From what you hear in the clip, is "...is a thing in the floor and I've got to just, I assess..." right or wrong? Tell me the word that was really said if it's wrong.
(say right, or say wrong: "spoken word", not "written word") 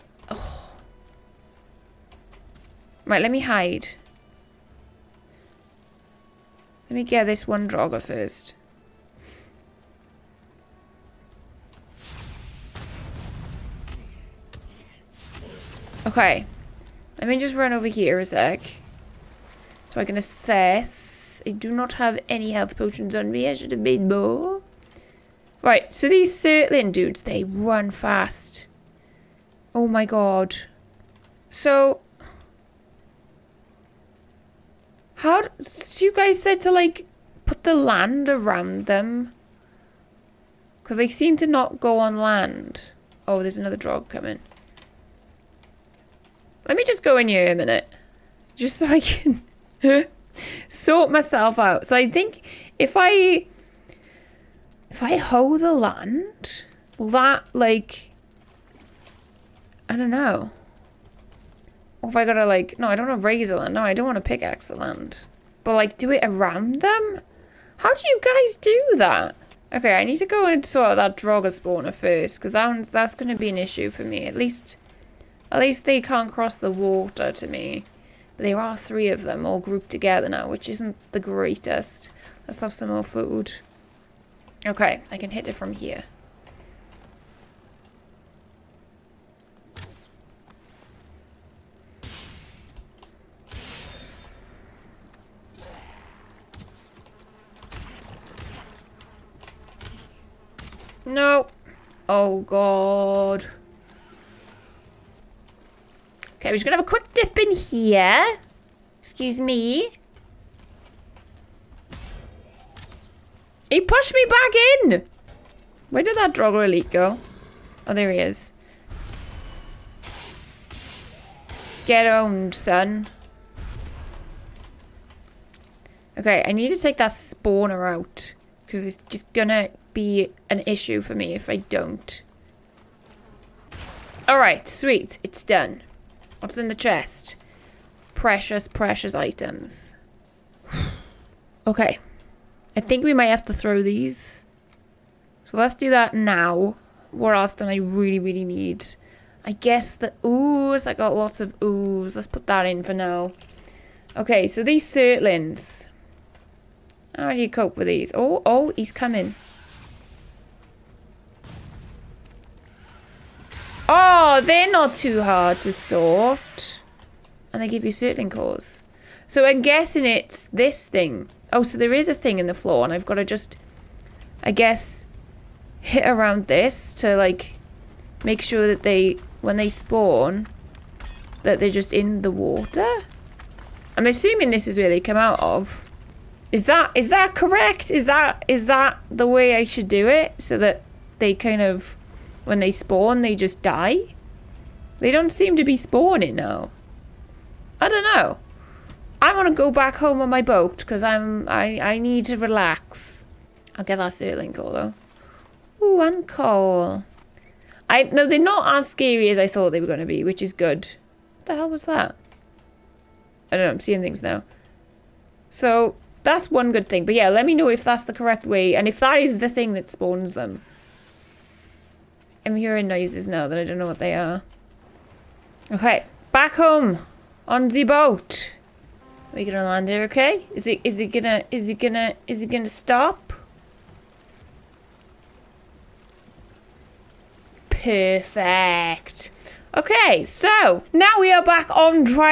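wrong: "guess", not "assess".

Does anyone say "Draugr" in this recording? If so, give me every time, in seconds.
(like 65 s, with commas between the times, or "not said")
7 s, 71 s, 116 s.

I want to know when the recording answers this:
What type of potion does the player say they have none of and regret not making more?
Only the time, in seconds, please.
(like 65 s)
22 s.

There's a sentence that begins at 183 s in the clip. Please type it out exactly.
I'm assuming this is where they come out of.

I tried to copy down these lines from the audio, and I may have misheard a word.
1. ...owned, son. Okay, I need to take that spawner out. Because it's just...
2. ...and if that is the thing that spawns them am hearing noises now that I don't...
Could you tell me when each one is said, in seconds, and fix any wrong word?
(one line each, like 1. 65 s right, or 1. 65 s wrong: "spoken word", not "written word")
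1. 122 s right
2. 218 s right.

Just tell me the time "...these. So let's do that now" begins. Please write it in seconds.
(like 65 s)
143 s.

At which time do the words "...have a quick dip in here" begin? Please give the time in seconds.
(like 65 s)
106 s.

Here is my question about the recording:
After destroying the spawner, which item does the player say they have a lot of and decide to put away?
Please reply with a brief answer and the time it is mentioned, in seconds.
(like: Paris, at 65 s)
Ooze, at 150 s.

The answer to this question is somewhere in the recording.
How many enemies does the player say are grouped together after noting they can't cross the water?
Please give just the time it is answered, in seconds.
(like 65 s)
78 s.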